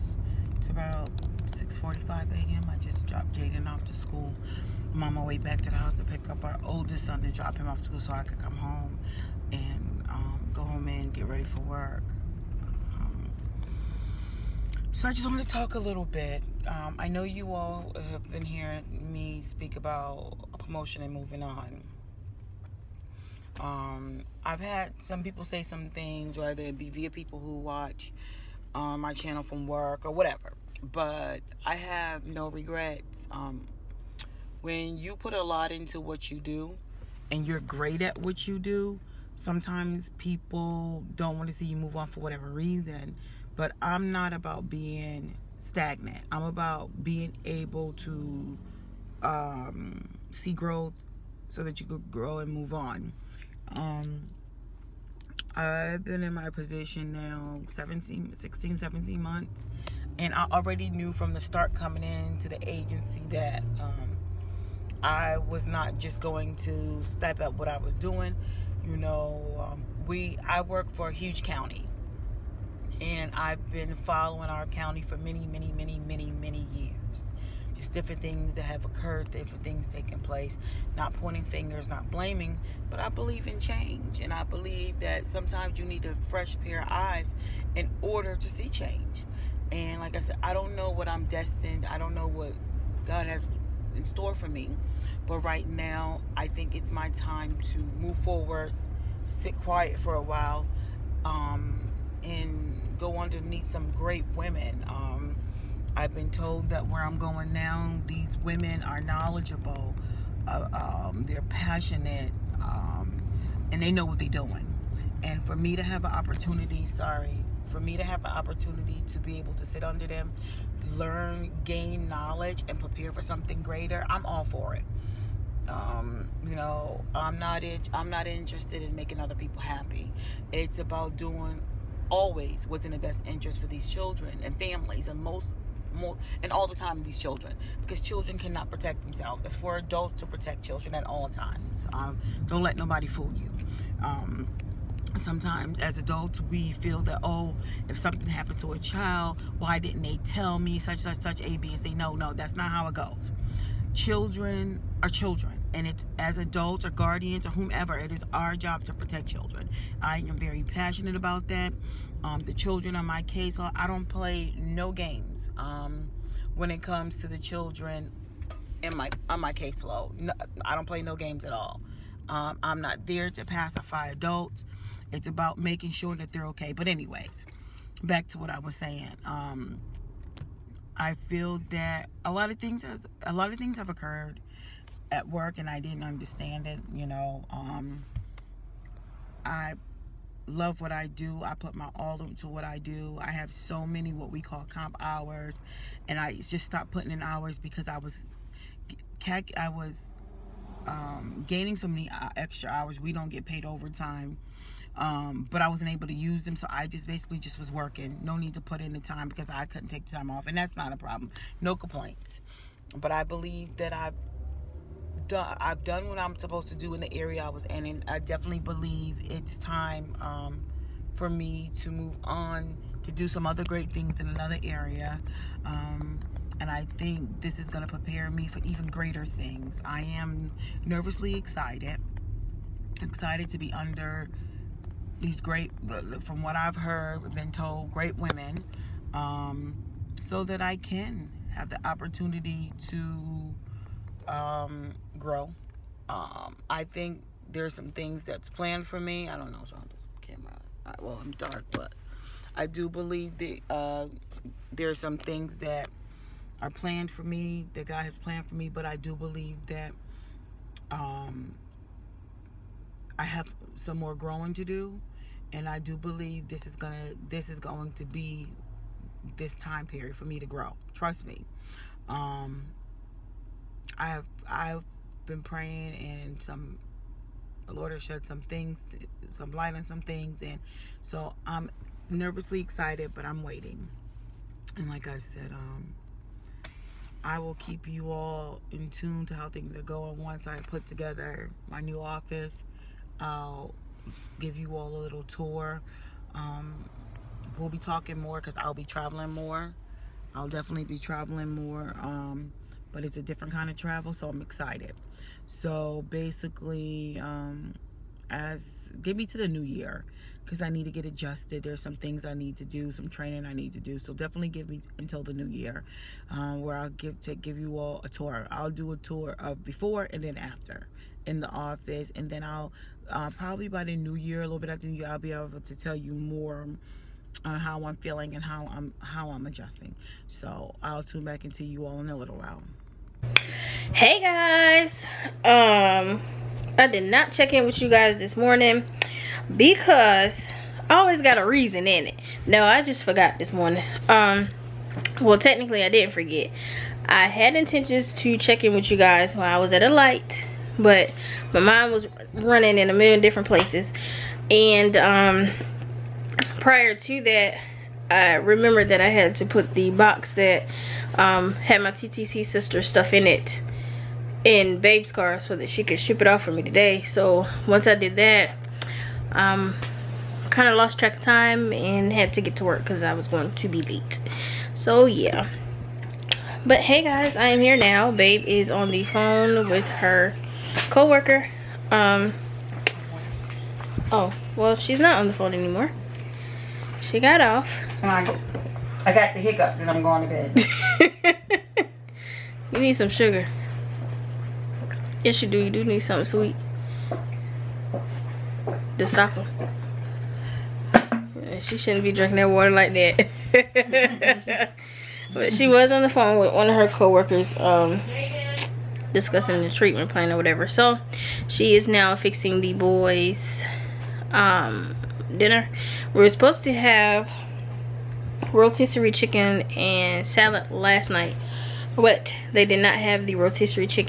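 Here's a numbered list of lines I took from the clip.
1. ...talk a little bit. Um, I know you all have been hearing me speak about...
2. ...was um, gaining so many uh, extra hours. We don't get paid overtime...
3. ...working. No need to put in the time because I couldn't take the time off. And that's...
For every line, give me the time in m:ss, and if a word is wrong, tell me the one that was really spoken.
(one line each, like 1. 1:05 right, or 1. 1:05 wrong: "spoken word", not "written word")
1. 0:15 right
2. 3:19 right
3. 3:27 right.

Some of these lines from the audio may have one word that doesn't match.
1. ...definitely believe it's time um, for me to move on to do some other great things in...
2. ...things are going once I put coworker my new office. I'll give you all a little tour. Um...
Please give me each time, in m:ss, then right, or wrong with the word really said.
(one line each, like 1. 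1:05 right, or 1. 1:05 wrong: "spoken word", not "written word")
1. 3:38 right
2. 4:49 wrong: "together", not "coworker".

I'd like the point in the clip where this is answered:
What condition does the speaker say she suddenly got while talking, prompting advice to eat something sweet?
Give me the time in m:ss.
6:29.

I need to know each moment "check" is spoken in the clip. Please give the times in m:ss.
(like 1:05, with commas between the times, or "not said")
5:37, 5:48.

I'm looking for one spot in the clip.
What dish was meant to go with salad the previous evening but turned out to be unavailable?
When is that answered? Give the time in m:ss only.
6:58.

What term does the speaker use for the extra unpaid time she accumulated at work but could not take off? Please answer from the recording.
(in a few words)
comp hours.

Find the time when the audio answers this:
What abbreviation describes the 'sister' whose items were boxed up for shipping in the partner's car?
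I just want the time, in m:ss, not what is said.
6:01.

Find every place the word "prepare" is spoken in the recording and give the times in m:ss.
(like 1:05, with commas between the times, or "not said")
2:02, 3:47.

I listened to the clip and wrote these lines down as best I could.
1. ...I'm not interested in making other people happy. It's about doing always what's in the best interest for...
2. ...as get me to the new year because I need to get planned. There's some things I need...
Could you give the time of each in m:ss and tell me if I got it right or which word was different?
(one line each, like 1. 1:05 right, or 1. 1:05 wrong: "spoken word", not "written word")
1. 2:07 right
2. 5:08 wrong: "adjusted", not "planned".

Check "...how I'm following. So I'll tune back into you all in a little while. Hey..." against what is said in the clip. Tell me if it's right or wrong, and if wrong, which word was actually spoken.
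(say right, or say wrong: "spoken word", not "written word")
wrong: "adjusting", not "following".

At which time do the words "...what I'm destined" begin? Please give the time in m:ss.
1:30.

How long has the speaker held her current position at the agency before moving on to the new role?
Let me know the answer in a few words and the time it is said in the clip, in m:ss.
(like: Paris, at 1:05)
16 to 17 months, at 0:57.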